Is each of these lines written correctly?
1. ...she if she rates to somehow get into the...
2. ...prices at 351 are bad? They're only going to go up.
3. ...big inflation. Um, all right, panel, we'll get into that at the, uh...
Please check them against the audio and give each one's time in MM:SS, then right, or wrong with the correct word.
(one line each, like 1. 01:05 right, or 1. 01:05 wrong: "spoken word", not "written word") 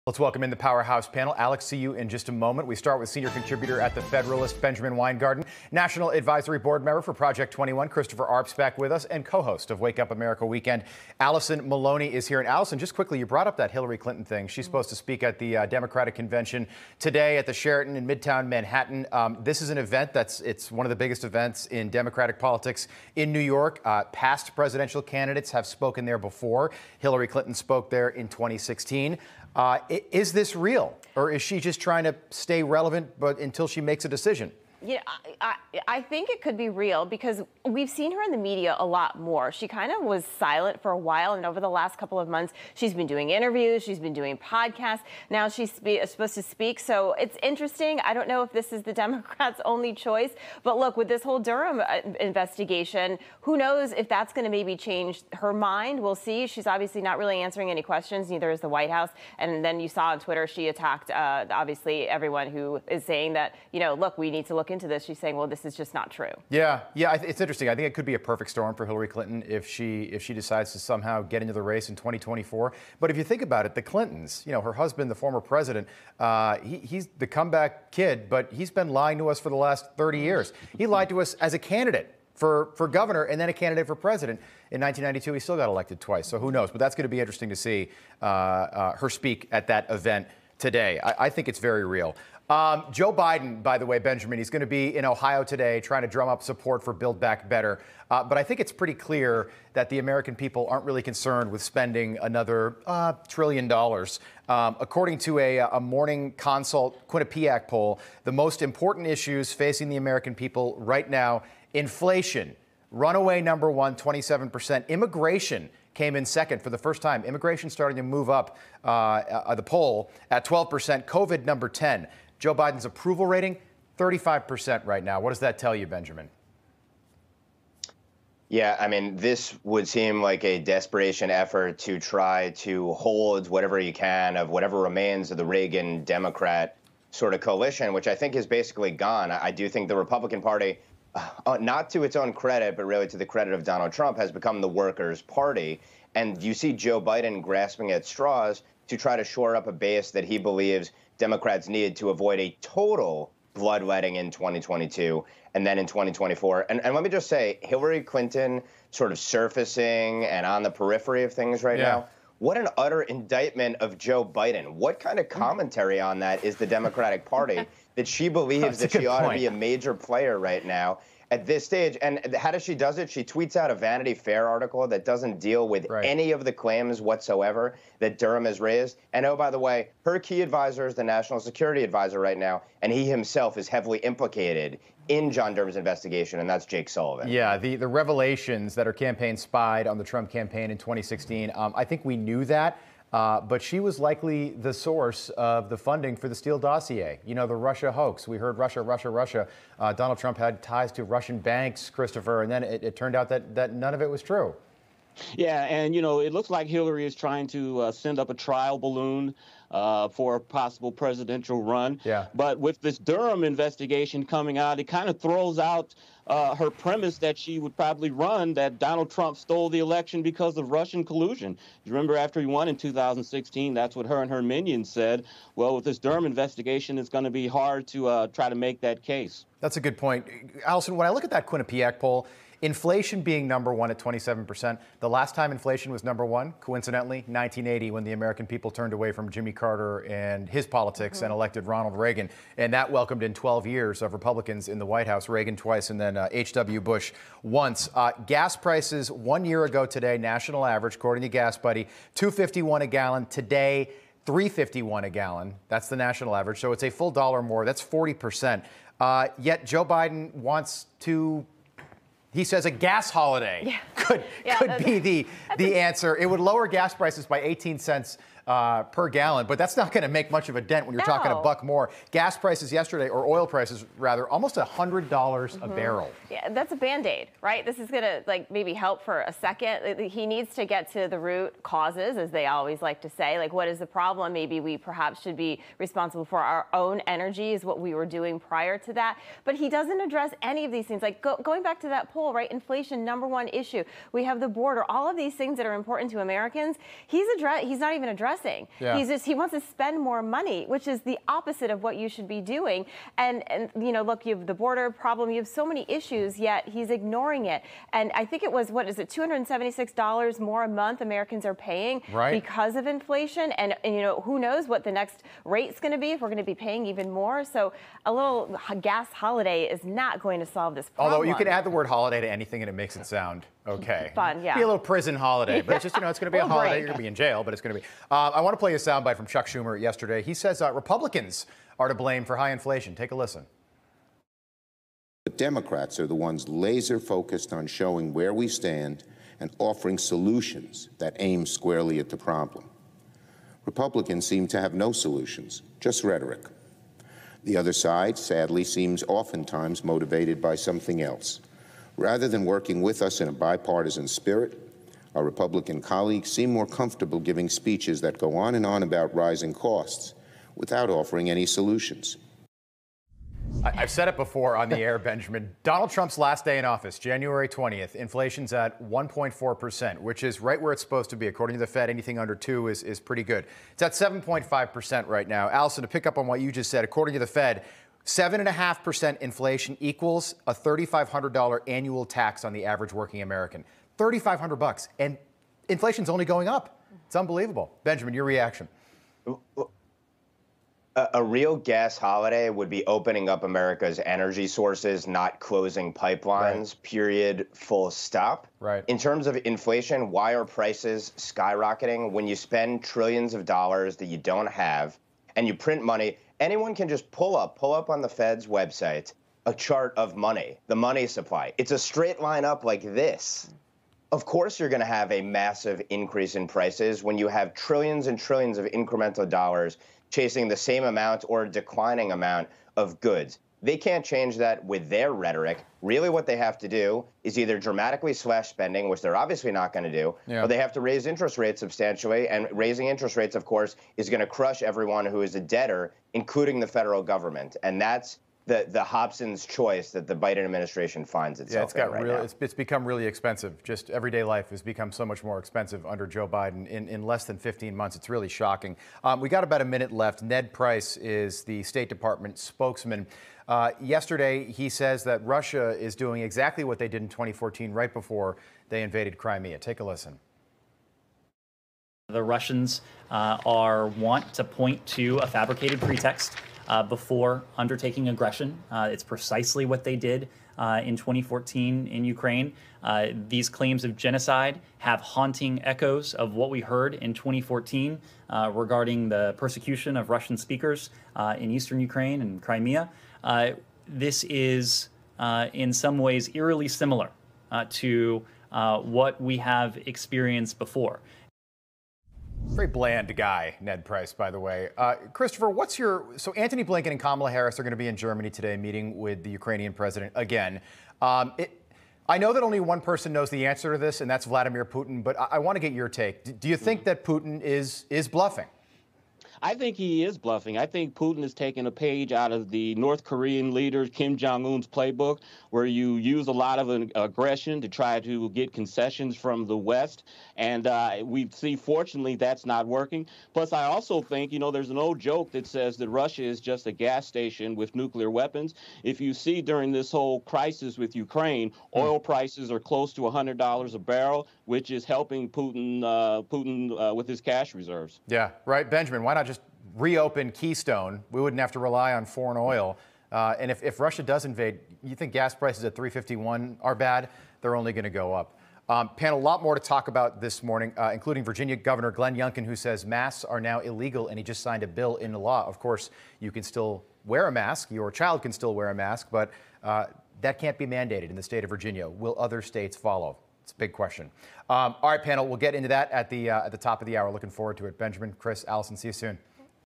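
1. 01:09 wrong: "decides", not "rates"
2. 09:05 right
3. 09:23 wrong: "question", not "inflation".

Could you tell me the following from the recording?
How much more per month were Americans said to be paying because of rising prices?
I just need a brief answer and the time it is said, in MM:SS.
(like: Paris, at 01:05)
$276, at 05:09.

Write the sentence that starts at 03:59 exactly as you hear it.
Carter and his politics mm -hmm.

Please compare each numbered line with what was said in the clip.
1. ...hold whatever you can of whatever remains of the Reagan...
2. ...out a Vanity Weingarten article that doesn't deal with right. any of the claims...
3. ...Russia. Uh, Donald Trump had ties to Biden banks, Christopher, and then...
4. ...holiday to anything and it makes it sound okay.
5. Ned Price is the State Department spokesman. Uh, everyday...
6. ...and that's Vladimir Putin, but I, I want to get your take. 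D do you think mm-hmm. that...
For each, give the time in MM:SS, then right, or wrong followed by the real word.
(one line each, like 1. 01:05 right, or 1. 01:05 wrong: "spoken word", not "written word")
1. 02:12 right
2. 02:53 wrong: "Fair", not "Weingarten"
3. 03:19 wrong: "Russian", not "Biden"
4. 05:22 right
5. 07:30 wrong: "yesterday", not "everyday"
6. 08:24 right.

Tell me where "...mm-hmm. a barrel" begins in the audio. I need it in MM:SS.
04:35.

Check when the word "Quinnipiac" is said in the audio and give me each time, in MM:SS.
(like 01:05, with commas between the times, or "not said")
01:47, 03:51.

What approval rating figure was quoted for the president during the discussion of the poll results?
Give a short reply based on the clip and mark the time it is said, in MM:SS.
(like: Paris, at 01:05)
35%, at 02:03.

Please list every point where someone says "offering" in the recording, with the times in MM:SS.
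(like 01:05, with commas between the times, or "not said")
05:39, 06:00.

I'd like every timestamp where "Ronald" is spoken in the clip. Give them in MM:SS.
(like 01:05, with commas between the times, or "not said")
04:01.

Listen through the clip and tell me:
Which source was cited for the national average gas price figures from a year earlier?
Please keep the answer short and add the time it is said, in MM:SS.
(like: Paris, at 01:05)
Gas Buddy, at 04:11.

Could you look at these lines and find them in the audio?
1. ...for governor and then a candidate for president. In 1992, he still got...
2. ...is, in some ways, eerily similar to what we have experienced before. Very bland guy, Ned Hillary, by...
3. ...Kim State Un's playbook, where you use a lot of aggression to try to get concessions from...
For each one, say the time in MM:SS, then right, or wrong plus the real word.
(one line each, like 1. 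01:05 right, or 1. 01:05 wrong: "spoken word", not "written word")
1. 01:22 right
2. 08:04 wrong: "Price", not "Hillary"
3. 08:33 wrong: "Jong", not "State".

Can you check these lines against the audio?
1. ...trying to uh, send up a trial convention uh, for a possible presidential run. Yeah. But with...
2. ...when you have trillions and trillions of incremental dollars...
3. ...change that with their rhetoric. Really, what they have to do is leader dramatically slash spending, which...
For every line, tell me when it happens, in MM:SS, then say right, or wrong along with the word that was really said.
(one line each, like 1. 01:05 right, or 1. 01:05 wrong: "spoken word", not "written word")
1. 03:27 wrong: "balloon", not "convention"
2. 06:57 right
3. 07:04 wrong: "either", not "leader".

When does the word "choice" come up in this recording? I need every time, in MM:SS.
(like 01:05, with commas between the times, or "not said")
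00:49, 07:19.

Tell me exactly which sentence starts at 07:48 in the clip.
Uh, it's precisely what they did uh, in 2014 in Ukraine.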